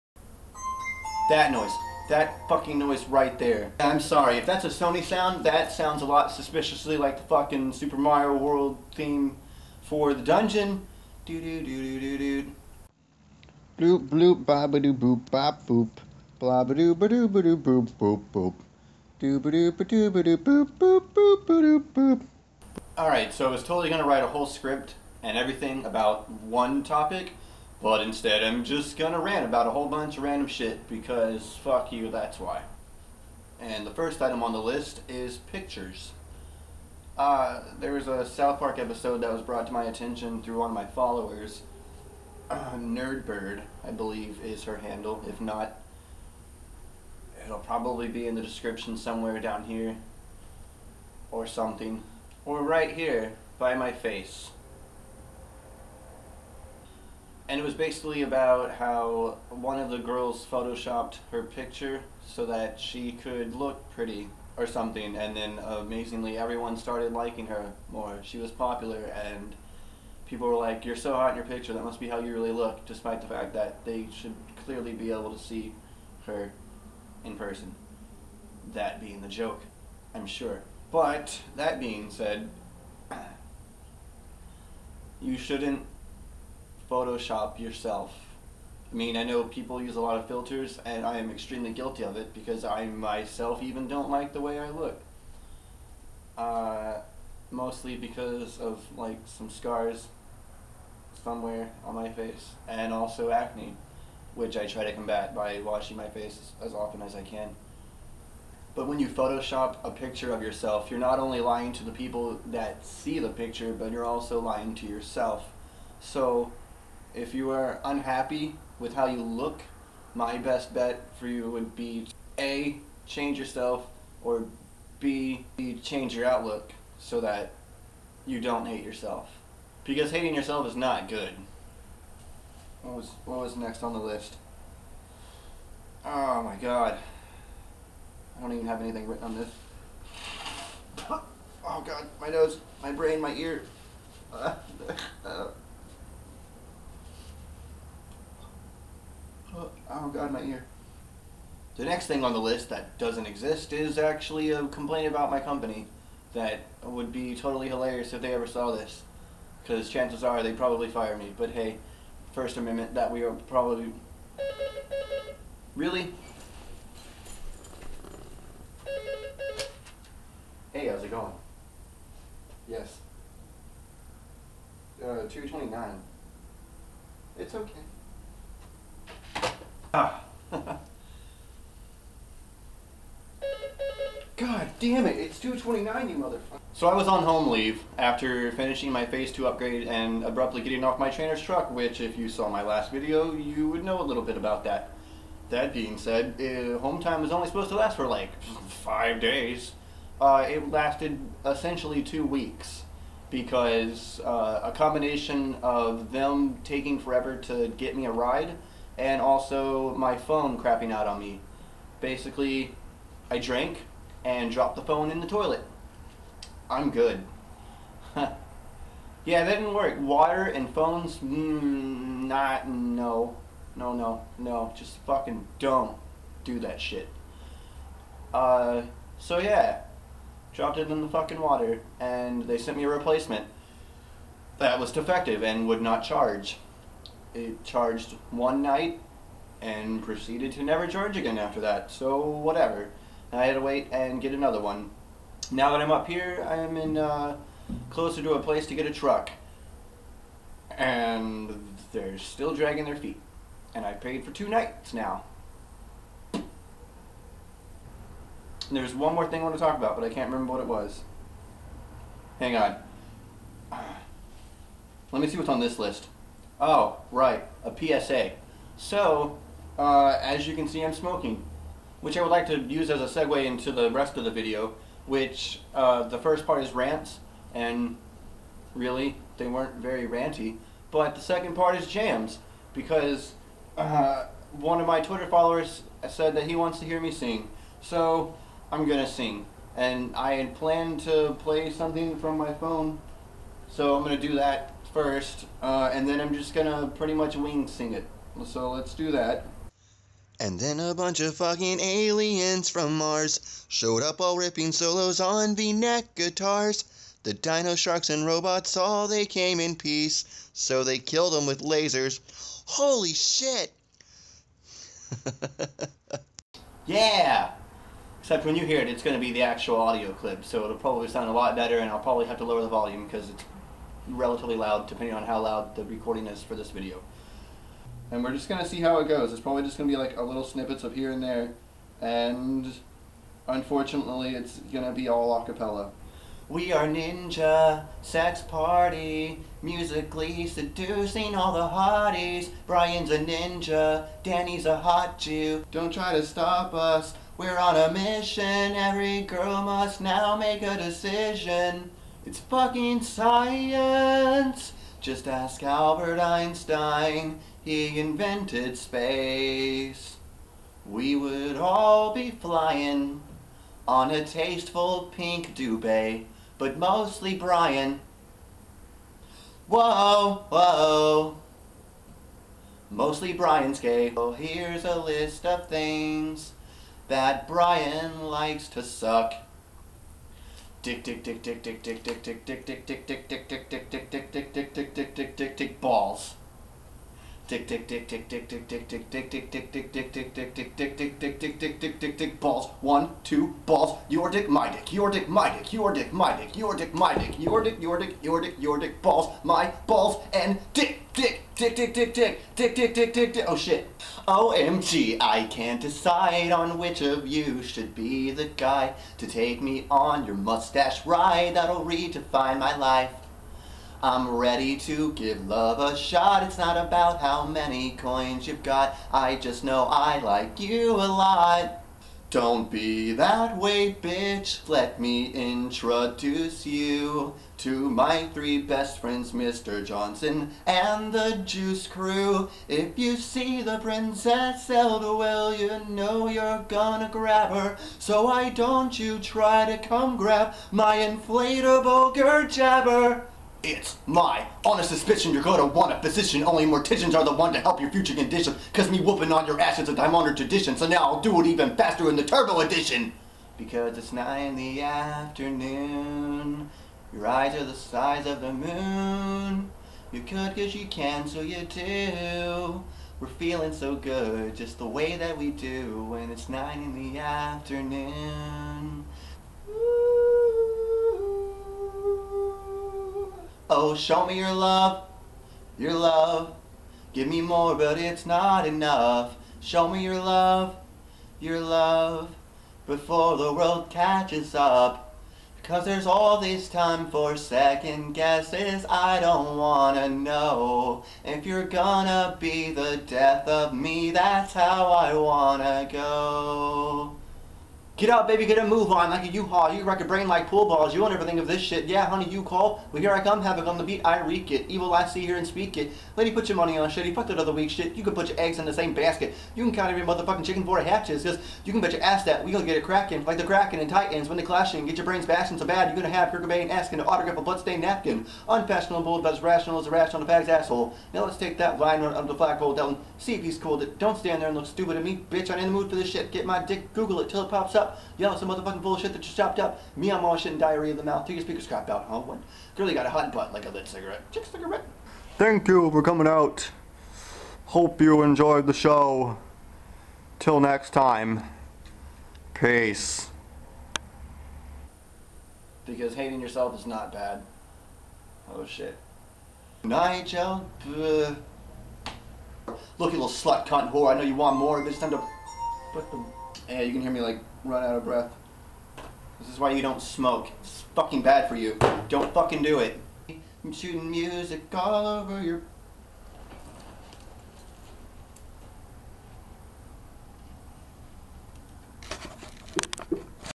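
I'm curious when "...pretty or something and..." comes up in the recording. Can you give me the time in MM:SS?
01:03.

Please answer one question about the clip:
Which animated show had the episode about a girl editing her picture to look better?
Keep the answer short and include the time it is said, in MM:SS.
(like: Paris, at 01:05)
South Park, at 00:38.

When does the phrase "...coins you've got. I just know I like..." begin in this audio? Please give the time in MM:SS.
06:57.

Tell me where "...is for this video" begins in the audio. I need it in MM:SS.
05:26.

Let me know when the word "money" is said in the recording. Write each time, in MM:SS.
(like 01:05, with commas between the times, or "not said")
08:26.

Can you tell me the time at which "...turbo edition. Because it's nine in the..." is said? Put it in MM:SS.
07:32.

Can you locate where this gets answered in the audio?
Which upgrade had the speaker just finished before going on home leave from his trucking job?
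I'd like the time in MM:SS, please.
03:09.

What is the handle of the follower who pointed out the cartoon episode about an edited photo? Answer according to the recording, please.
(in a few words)
Nerdbird.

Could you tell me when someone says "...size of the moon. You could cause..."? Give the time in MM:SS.
07:37.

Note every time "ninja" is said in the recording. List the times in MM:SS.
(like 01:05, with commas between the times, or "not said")
05:36, 05:43.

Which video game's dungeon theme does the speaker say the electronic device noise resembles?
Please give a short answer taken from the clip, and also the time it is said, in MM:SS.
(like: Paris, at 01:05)
Super Mario World, at 00:07.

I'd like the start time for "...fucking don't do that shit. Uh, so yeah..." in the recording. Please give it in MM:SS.
03:45.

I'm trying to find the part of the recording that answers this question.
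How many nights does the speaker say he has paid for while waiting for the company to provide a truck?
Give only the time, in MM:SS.
04:14.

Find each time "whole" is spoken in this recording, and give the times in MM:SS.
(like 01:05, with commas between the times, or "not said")
00:24, 00:29.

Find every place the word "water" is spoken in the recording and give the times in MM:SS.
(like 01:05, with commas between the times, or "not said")
03:39, 03:51.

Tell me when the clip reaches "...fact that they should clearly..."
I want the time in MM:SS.
01:13.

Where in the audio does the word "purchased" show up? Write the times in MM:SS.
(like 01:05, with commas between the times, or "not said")
not said.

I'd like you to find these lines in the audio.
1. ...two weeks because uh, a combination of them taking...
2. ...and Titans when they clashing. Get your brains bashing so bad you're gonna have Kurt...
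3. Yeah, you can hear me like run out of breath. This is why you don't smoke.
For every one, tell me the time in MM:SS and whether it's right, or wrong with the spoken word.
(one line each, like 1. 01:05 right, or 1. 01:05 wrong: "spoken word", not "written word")
1. 03:22 right
2. 08:33 right
3. 09:16 right.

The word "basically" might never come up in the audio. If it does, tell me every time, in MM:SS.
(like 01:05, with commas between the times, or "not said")
00:57, 03:32.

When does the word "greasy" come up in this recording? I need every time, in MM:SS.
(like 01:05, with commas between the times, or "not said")
not said.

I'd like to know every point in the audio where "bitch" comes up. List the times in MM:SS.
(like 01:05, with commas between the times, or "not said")
07:04, 08:45.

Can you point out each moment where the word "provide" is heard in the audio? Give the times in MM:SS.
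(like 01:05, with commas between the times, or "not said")
not said.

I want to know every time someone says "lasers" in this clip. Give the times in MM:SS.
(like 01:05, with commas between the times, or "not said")
05:11.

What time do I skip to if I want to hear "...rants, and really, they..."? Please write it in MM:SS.
04:36.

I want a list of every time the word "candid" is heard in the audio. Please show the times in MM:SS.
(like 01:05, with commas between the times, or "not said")
not said.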